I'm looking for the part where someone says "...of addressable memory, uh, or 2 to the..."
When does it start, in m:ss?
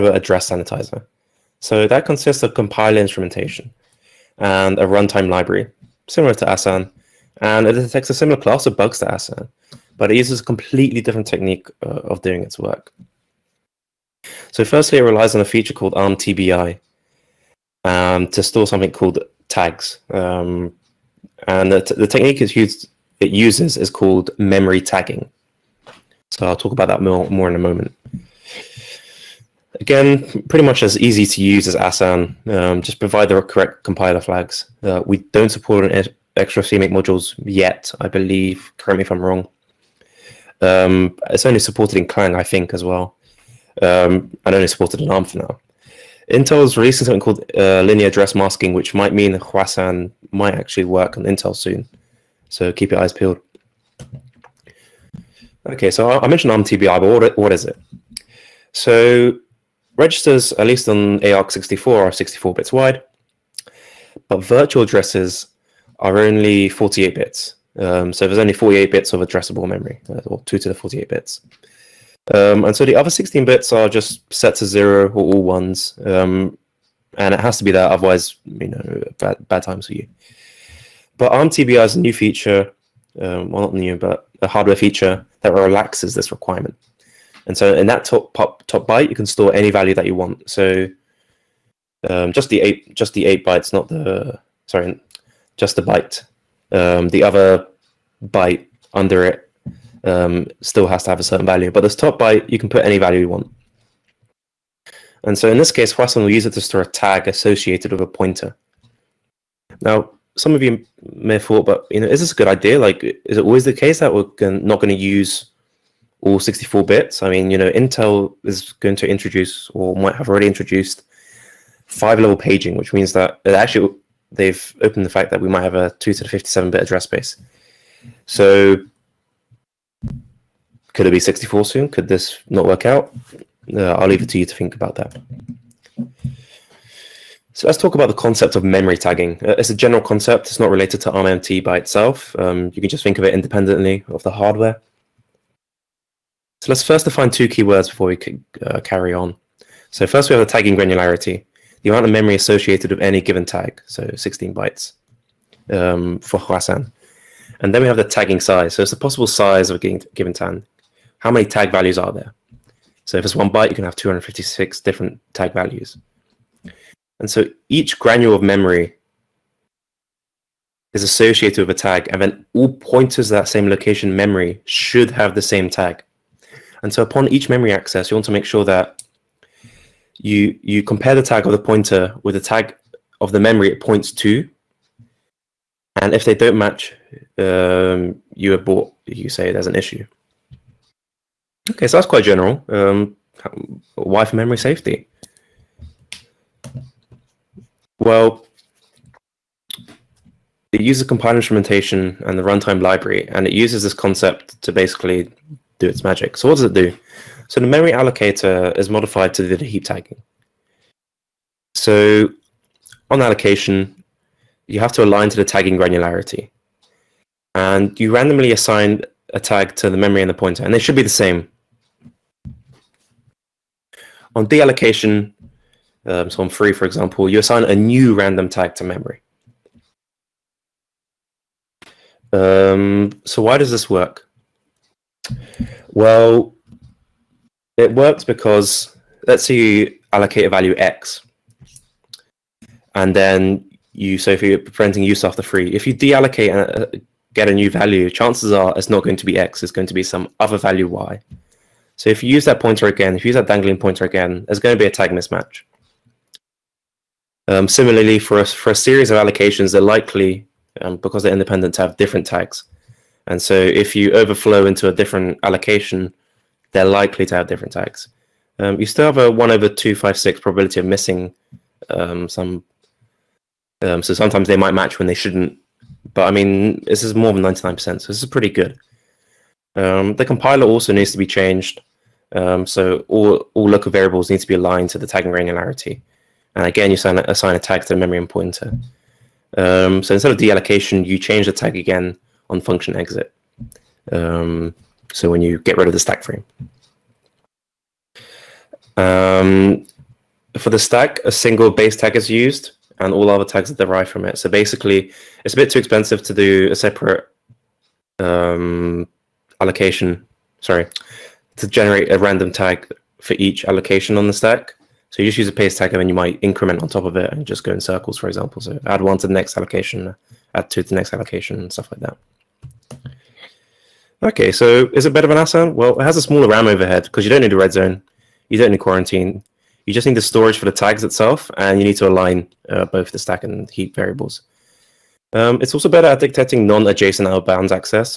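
1:09.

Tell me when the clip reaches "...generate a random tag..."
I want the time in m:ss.
5:11.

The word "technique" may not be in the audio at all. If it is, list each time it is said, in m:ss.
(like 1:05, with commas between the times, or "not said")
0:11, 0:22.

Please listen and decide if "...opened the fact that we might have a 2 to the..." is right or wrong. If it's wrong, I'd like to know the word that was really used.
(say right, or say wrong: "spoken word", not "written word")
right.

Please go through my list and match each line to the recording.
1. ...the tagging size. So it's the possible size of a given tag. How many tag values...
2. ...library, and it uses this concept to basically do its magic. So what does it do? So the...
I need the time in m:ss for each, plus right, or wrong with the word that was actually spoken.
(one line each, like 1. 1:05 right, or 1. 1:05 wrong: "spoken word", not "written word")
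1. 2:37 right
2. 3:22 right.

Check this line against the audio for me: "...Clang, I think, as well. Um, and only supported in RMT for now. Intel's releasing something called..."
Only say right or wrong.
wrong.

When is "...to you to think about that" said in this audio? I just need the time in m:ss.
2:14.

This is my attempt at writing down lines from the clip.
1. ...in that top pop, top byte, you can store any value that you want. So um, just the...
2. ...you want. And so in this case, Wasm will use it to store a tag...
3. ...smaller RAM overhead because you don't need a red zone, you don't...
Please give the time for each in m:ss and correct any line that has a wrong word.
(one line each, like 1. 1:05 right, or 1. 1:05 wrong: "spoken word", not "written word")
1. 1:27 right
2. 1:43 right
3. 5:26 right.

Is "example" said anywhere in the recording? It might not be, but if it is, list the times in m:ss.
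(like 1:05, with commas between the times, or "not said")
3:46, 5:18.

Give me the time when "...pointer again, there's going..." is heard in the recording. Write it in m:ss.
4:13.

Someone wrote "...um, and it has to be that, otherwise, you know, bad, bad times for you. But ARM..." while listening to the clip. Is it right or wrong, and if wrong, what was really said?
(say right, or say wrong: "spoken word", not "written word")
right.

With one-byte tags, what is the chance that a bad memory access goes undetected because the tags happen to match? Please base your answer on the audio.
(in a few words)
1 in 256.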